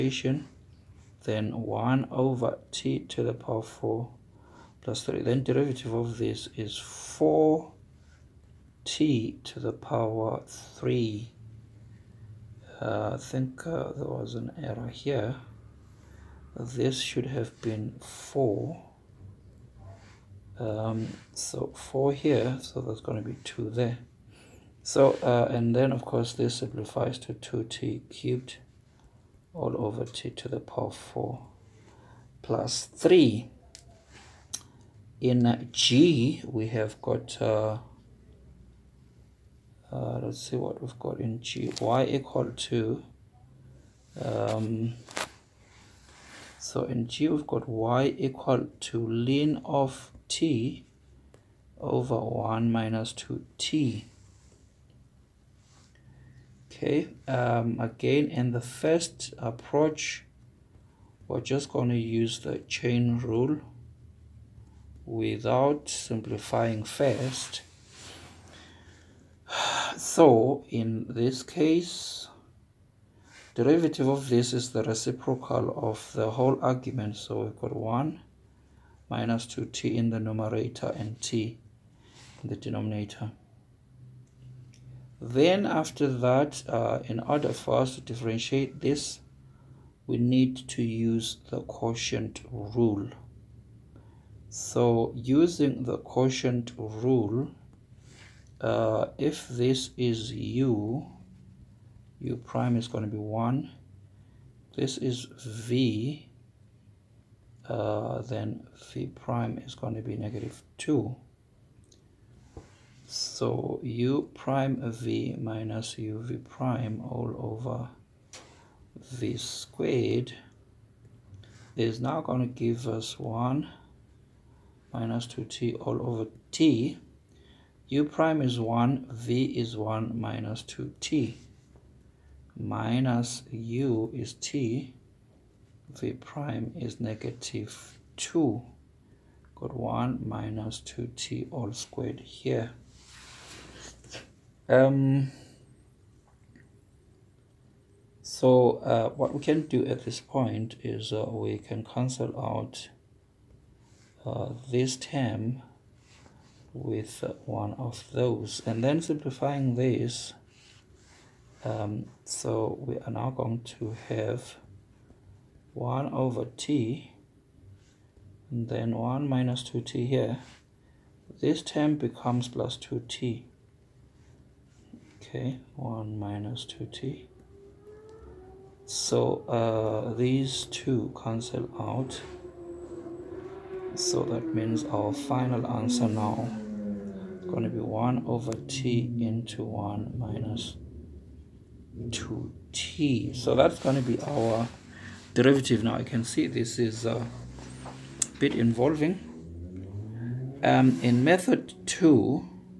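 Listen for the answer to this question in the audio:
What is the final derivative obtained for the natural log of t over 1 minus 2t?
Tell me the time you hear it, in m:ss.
3:07.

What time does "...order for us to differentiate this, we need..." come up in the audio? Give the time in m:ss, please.
1:27.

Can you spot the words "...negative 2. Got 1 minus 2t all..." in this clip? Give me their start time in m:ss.
2:16.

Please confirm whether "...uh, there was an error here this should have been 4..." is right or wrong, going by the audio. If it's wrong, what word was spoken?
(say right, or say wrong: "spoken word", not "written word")
right.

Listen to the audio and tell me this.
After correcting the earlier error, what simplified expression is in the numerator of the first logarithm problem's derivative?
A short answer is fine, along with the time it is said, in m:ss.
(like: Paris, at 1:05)
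2t cubed, at 0:27.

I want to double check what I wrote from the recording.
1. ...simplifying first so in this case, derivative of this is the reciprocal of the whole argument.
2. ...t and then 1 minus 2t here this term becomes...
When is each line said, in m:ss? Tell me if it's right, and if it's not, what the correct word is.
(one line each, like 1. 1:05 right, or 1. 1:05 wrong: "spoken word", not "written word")
1. 1:06 right
2. 2:46 right.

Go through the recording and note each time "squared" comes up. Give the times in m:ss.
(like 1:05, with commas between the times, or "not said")
1:59, 2:21.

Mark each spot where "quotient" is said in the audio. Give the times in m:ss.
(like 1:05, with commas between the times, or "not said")
1:31, 1:35.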